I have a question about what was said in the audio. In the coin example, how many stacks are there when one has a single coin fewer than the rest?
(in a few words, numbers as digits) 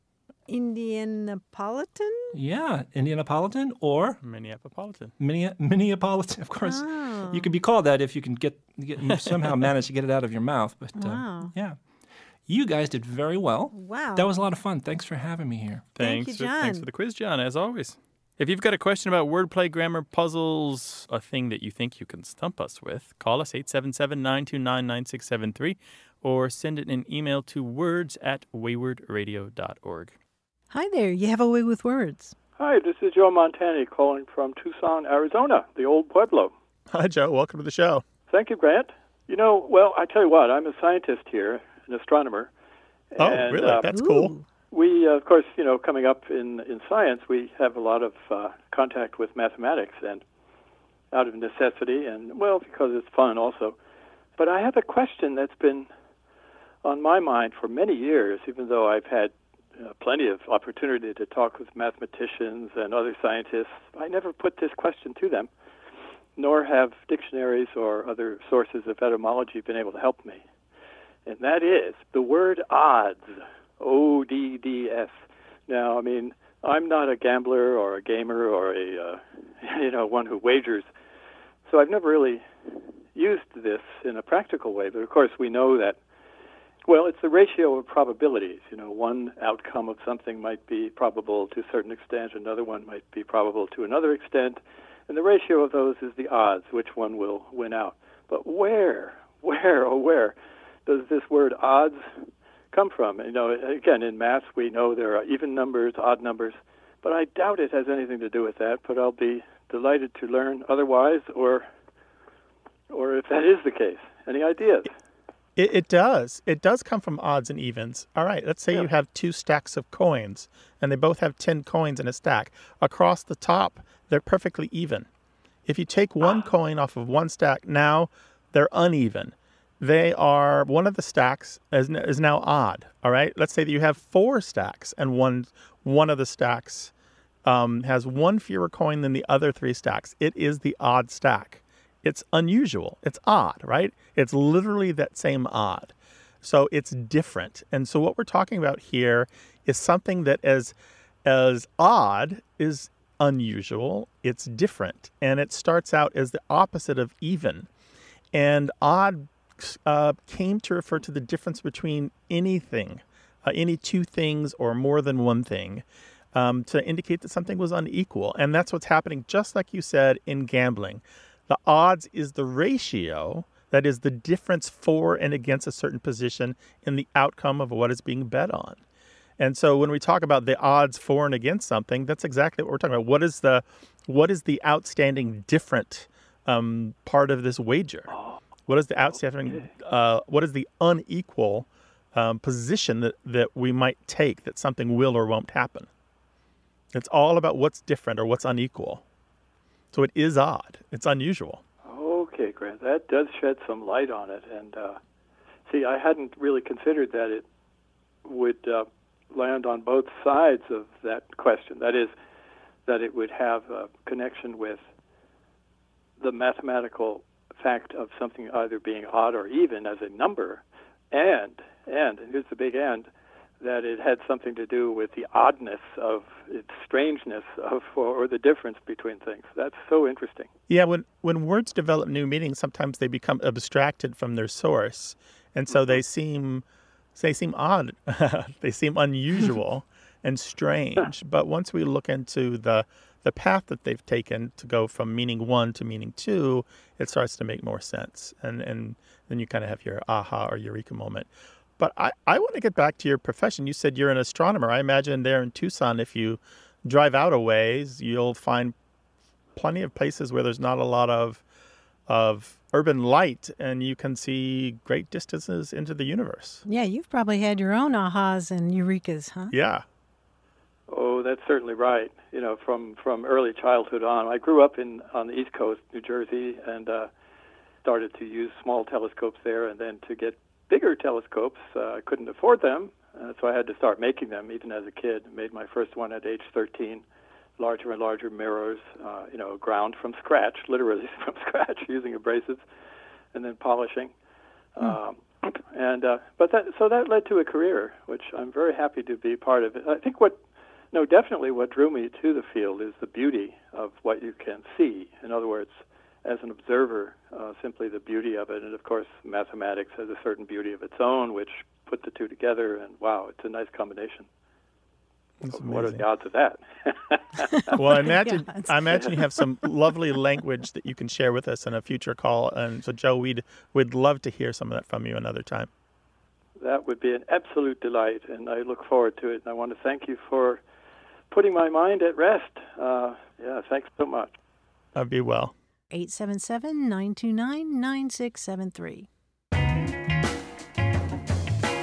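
4.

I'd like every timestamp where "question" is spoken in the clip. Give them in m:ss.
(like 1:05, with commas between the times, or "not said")
0:18, 0:54, 1:04, 3:31.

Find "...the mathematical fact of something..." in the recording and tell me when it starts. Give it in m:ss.
3:36.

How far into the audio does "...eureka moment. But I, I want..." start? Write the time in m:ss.
4:10.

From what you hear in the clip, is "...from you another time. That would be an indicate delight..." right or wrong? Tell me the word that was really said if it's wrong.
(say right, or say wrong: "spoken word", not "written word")
wrong: "absolute", not "indicate".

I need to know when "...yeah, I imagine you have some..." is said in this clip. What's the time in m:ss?
5:18.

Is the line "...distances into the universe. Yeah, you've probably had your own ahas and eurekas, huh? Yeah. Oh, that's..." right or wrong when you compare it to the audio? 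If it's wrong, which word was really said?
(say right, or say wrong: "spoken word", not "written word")
right.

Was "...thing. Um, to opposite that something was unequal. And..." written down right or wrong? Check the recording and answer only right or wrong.
wrong.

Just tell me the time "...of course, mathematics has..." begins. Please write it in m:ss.
5:08.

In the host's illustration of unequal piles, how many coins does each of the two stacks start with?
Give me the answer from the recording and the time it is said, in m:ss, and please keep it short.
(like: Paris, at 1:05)
10, at 2:01.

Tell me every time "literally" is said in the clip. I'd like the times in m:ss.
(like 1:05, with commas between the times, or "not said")
2:24, 4:50.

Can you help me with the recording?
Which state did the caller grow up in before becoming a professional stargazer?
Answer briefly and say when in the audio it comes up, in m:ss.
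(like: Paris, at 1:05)
New Jersey, at 4:35.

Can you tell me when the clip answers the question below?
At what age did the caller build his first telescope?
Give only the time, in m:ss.
4:46.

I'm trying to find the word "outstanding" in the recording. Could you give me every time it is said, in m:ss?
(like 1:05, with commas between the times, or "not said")
3:04, 3:09.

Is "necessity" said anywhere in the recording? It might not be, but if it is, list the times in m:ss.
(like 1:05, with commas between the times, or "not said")
0:51.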